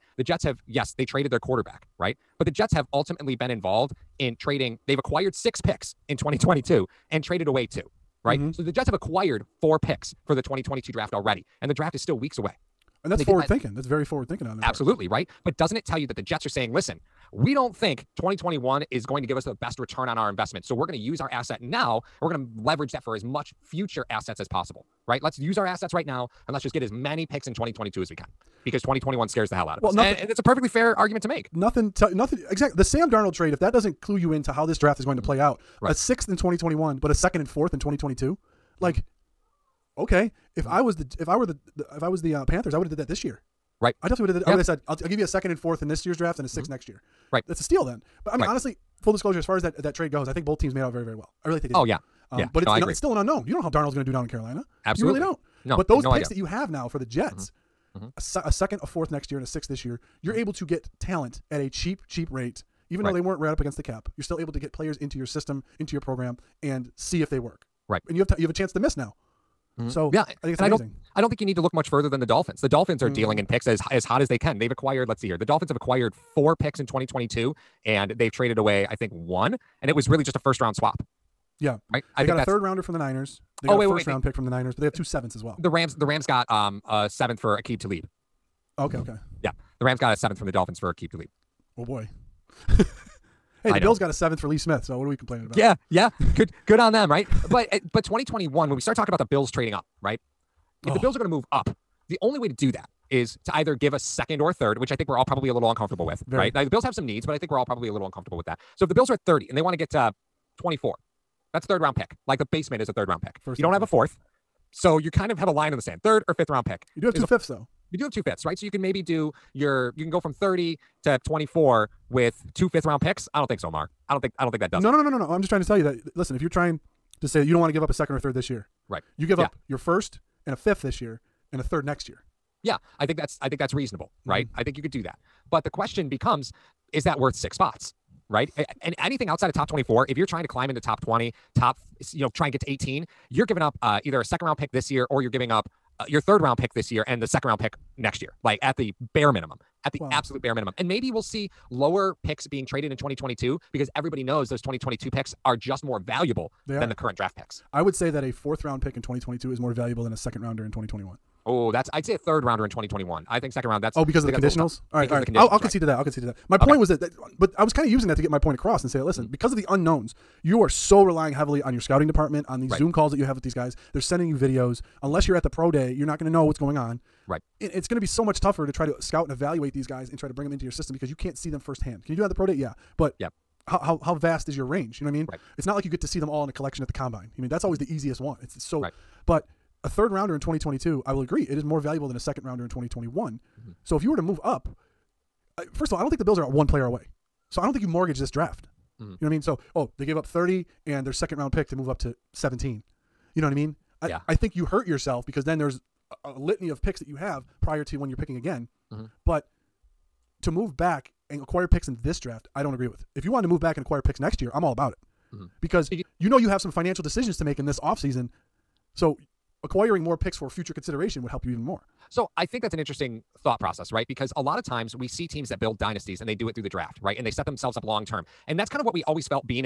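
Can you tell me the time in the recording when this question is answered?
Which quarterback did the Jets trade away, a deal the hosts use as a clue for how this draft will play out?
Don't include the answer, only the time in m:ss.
0:32.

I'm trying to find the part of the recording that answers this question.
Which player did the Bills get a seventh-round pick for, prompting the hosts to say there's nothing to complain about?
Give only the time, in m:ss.
1:34.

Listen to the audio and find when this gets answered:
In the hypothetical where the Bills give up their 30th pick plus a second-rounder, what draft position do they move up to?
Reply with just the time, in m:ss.
3:22.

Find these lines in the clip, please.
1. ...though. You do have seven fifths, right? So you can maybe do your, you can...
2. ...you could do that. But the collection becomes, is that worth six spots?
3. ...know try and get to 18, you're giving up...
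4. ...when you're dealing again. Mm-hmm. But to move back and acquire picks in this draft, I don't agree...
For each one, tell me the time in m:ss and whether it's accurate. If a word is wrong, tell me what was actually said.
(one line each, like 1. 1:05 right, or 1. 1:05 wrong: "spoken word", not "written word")
1. 1:57 wrong: "two", not "seven"
2. 2:14 wrong: "question", not "collection"
3. 2:22 right
4. 3:27 wrong: "picking", not "dealing".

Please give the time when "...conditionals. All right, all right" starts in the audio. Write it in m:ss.
2:44.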